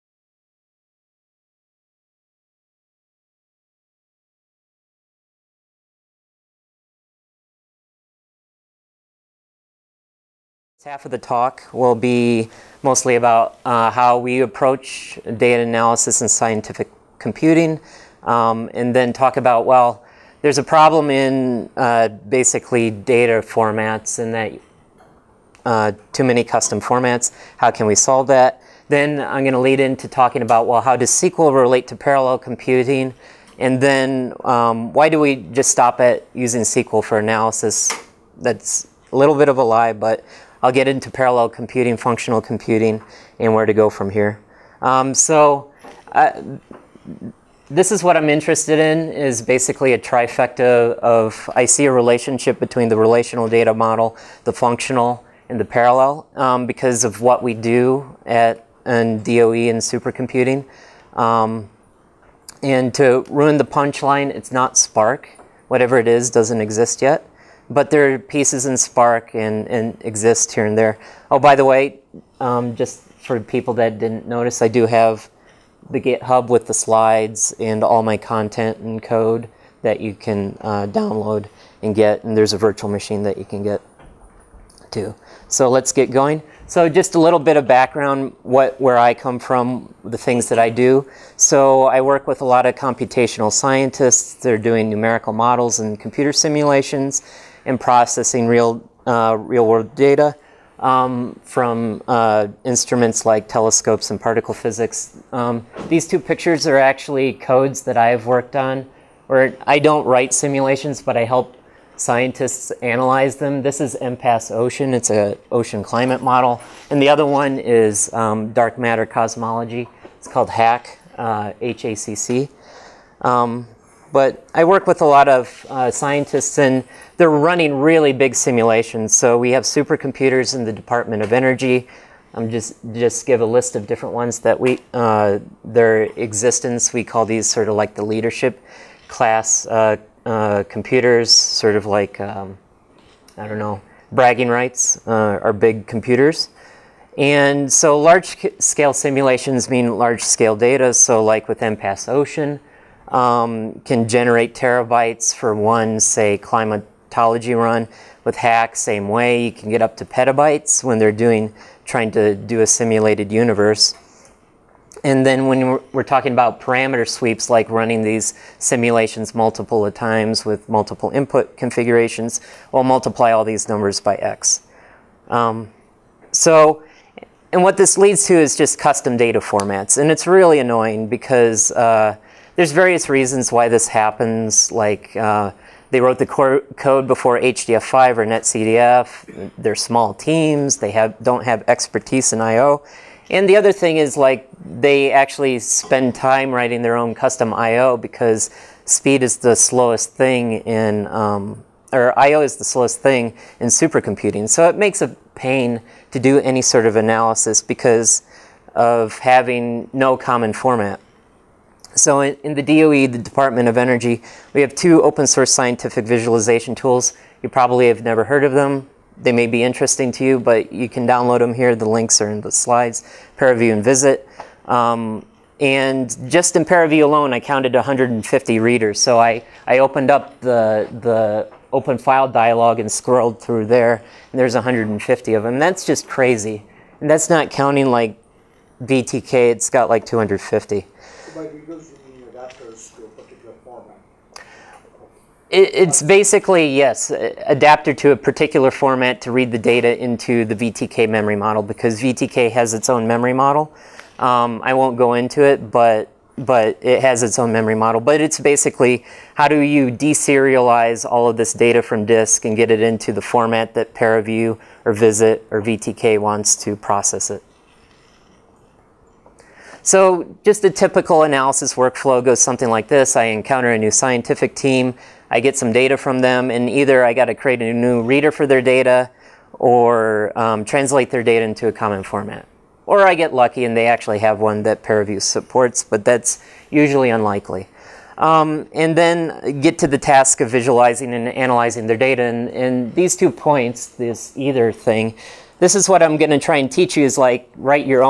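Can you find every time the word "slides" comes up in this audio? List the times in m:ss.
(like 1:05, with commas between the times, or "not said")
1:16, 3:42.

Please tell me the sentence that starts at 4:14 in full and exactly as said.
Um, I won't go into it, but, but it has its own memory model.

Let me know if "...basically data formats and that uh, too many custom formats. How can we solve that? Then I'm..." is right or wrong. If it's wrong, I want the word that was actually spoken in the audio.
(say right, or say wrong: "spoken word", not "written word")
right.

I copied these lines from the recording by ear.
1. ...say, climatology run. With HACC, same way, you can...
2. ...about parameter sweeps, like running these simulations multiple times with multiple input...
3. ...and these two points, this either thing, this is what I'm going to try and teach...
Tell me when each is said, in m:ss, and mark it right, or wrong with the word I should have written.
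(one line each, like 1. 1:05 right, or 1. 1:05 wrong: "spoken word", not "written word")
1. 2:35 right
2. 2:46 right
3. 4:52 right.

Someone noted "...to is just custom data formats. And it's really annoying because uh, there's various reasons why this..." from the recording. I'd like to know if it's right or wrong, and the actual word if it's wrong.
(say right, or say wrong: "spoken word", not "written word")
right.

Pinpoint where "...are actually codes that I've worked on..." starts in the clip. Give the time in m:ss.
1:46.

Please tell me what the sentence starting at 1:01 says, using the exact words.
Um, and to ruin the punchline, it's not Spark.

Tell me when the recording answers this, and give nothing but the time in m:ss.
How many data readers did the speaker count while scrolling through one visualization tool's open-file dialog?
3:47.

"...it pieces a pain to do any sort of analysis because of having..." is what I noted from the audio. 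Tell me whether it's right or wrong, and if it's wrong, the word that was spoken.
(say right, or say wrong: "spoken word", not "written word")
wrong: "makes", not "pieces".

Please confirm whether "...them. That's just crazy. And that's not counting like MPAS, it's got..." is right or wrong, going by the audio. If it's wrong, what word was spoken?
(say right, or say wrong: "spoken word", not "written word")
wrong: "VTK", not "MPAS".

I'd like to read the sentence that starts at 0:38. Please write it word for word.
That's a little bit of a lie, but I'll get into parallel computing, functional computing, and where to go from here.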